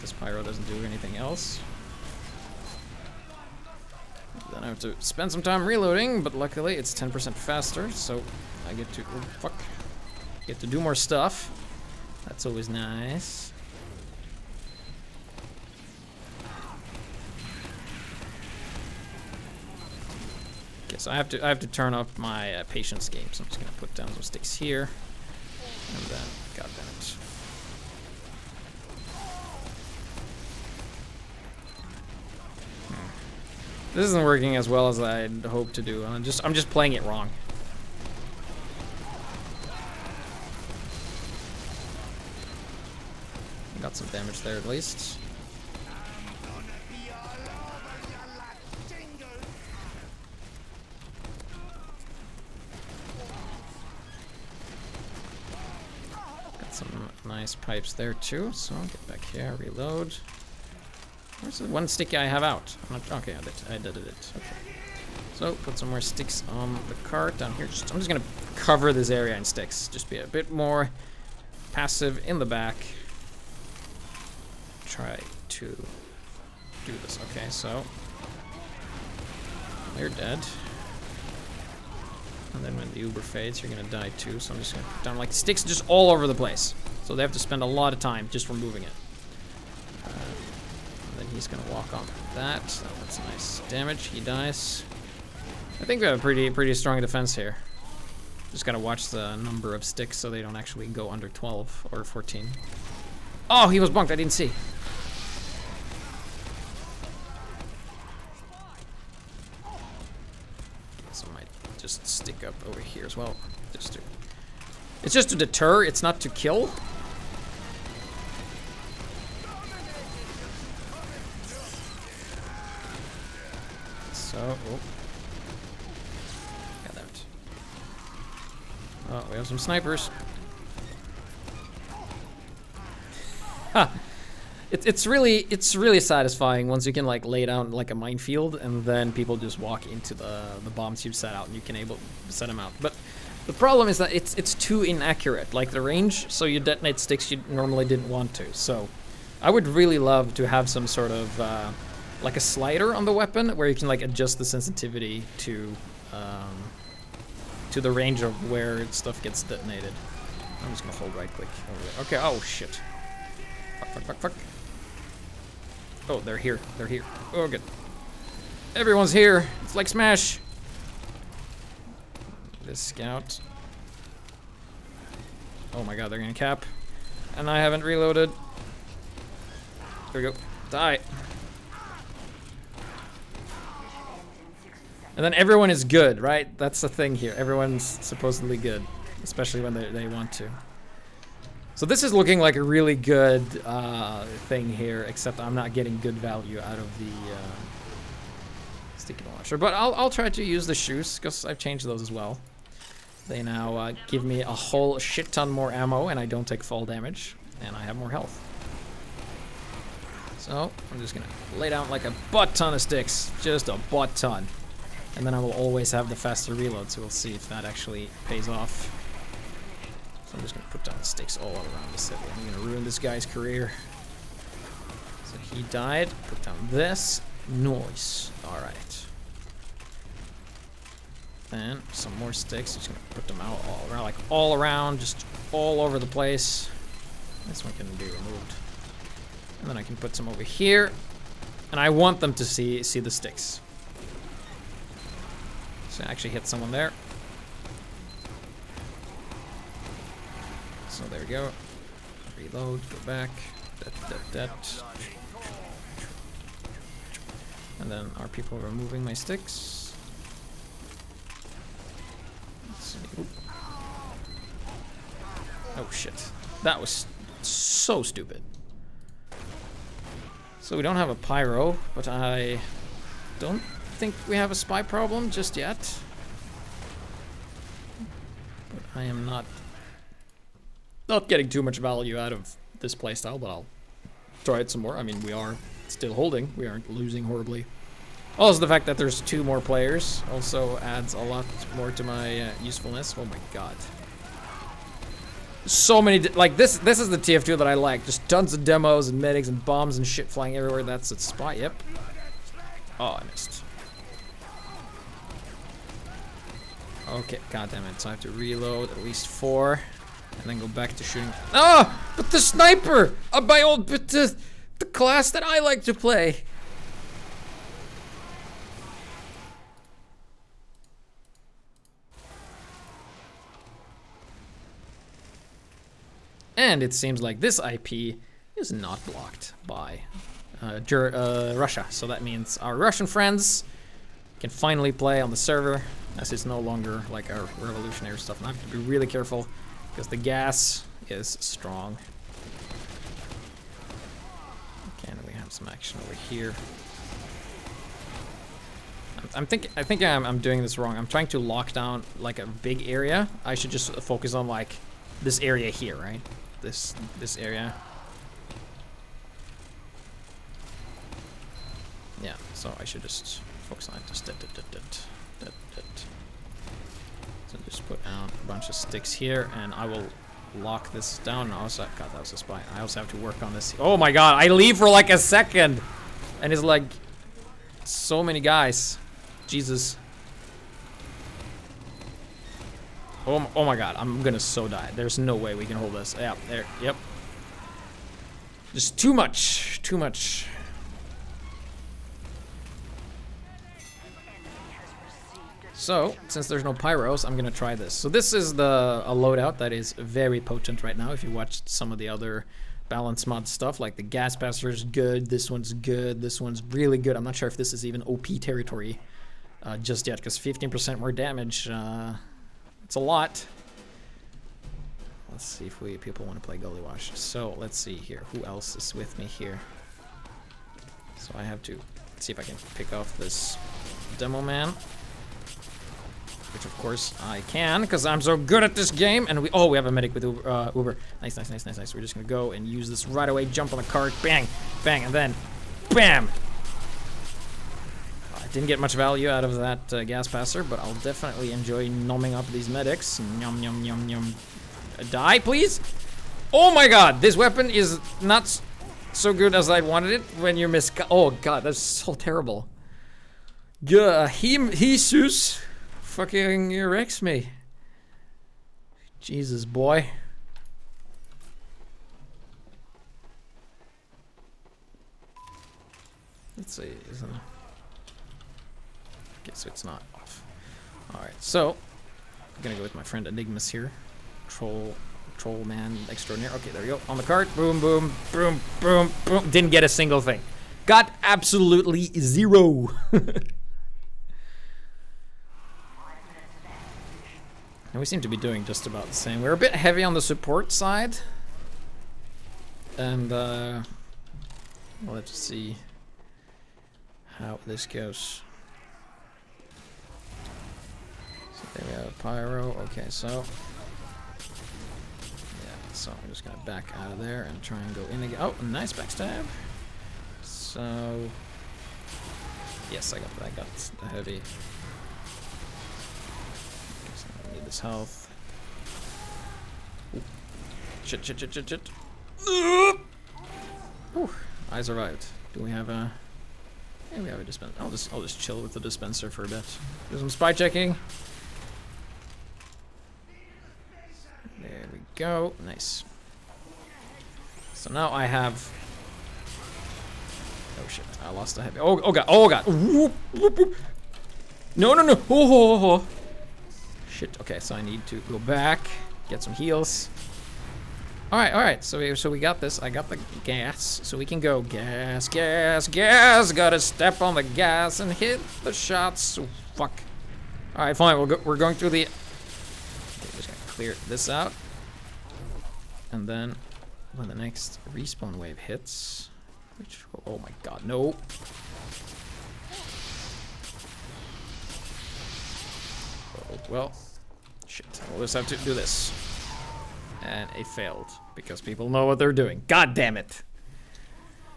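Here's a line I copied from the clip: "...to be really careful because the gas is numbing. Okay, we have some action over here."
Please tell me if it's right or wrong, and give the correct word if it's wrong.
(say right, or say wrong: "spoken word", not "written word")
wrong: "strong", not "numbing".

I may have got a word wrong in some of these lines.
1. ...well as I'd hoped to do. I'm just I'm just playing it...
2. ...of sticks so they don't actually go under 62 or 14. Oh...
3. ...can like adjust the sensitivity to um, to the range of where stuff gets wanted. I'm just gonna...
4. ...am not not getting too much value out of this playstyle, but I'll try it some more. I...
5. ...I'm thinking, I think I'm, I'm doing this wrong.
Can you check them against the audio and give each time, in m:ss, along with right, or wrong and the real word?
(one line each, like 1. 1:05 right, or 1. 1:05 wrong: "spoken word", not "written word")
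1. 0:34 right
2. 1:39 wrong: "12", not "62"
3. 2:33 wrong: "detonated", not "wanted"
4. 4:39 right
5. 5:49 right.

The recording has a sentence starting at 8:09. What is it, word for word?
We're a bit heavy on the support side.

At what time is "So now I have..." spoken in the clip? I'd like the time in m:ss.
8:57.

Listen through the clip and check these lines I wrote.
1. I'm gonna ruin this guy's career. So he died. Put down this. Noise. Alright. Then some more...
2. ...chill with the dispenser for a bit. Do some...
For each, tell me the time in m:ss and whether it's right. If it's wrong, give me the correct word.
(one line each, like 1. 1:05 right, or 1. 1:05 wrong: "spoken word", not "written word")
1. 3:42 right
2. 8:48 right.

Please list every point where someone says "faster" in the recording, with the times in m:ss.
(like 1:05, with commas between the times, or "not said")
0:07, 3:36.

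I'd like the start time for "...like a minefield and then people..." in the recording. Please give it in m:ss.
2:17.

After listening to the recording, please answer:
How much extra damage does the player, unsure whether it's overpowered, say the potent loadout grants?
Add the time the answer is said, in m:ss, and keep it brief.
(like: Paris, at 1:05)
15%, at 6:50.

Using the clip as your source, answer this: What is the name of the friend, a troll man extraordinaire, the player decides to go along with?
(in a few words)
Enigmas.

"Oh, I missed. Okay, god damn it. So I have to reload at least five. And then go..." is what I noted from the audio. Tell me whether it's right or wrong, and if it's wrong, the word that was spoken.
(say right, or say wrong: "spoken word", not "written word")
wrong: "four", not "five".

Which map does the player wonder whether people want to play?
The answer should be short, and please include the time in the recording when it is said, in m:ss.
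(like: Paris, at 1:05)
Gullywash, at 6:56.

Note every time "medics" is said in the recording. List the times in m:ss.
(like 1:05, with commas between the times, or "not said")
4:59, 7:09, 7:22.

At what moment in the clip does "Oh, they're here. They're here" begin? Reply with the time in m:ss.
2:46.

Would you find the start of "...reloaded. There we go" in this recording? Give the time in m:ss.
2:57.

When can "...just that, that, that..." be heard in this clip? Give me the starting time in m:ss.
6:04.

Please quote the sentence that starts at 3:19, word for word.
But I'll, I'll try to use the shoes, because I've changed those as well.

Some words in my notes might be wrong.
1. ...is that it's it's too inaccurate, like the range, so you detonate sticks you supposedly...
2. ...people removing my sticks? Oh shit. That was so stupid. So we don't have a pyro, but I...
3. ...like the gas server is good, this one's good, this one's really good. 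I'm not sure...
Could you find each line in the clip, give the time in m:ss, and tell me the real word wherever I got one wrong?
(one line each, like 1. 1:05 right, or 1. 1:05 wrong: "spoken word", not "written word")
1. 2:23 wrong: "normally", not "supposedly"
2. 4:18 right
3. 6:43 wrong: "passer", not "server".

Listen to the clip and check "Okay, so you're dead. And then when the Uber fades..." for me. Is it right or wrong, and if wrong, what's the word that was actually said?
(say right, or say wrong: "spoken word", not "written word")
right.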